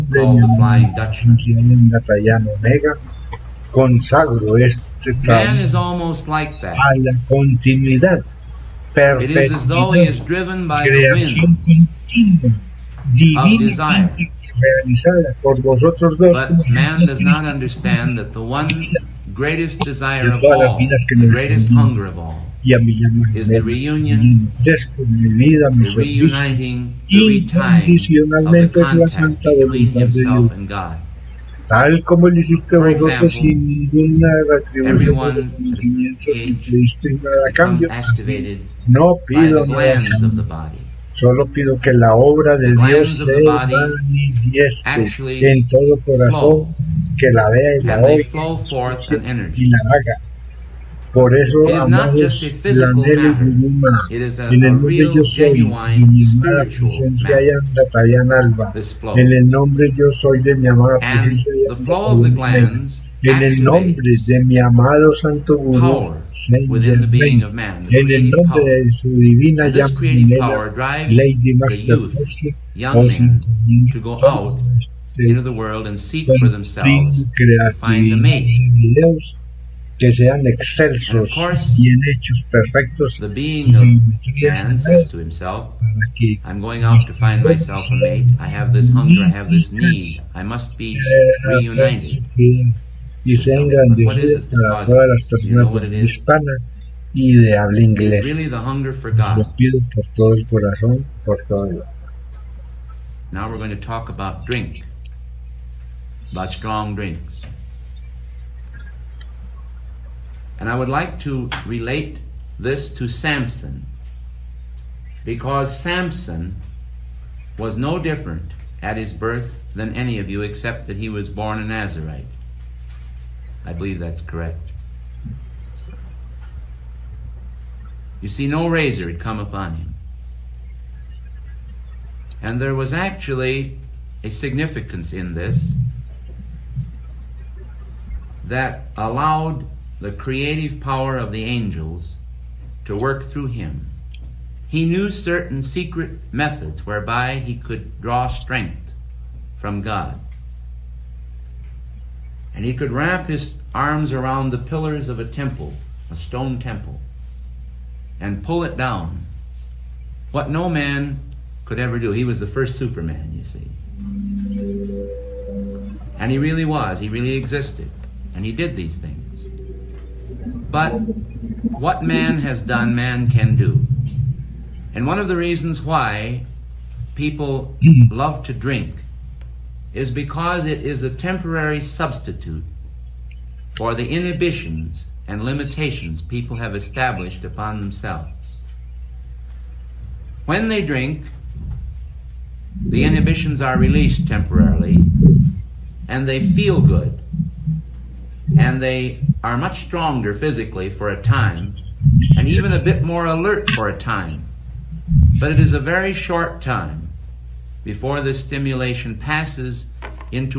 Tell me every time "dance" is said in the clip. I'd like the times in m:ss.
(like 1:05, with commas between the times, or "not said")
not said.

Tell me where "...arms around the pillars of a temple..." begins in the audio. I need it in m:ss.
2:33.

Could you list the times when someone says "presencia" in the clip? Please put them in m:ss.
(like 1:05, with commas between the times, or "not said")
0:56, 1:00.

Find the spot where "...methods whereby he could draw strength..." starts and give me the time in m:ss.
2:26.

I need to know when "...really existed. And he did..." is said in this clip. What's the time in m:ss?
2:47.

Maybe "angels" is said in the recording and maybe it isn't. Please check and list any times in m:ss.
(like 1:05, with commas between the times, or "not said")
2:21.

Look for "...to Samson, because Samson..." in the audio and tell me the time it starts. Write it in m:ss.
1:52.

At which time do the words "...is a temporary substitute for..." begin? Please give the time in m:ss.
3:00.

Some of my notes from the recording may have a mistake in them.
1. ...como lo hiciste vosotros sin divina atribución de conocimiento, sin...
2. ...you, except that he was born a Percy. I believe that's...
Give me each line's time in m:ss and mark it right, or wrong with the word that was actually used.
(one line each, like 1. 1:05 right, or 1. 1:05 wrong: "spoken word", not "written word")
1. 0:32 wrong: "ninguna", not "divina"
2. 2:00 wrong: "Nazarite", not "Percy".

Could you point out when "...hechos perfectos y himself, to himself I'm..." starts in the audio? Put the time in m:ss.
1:22.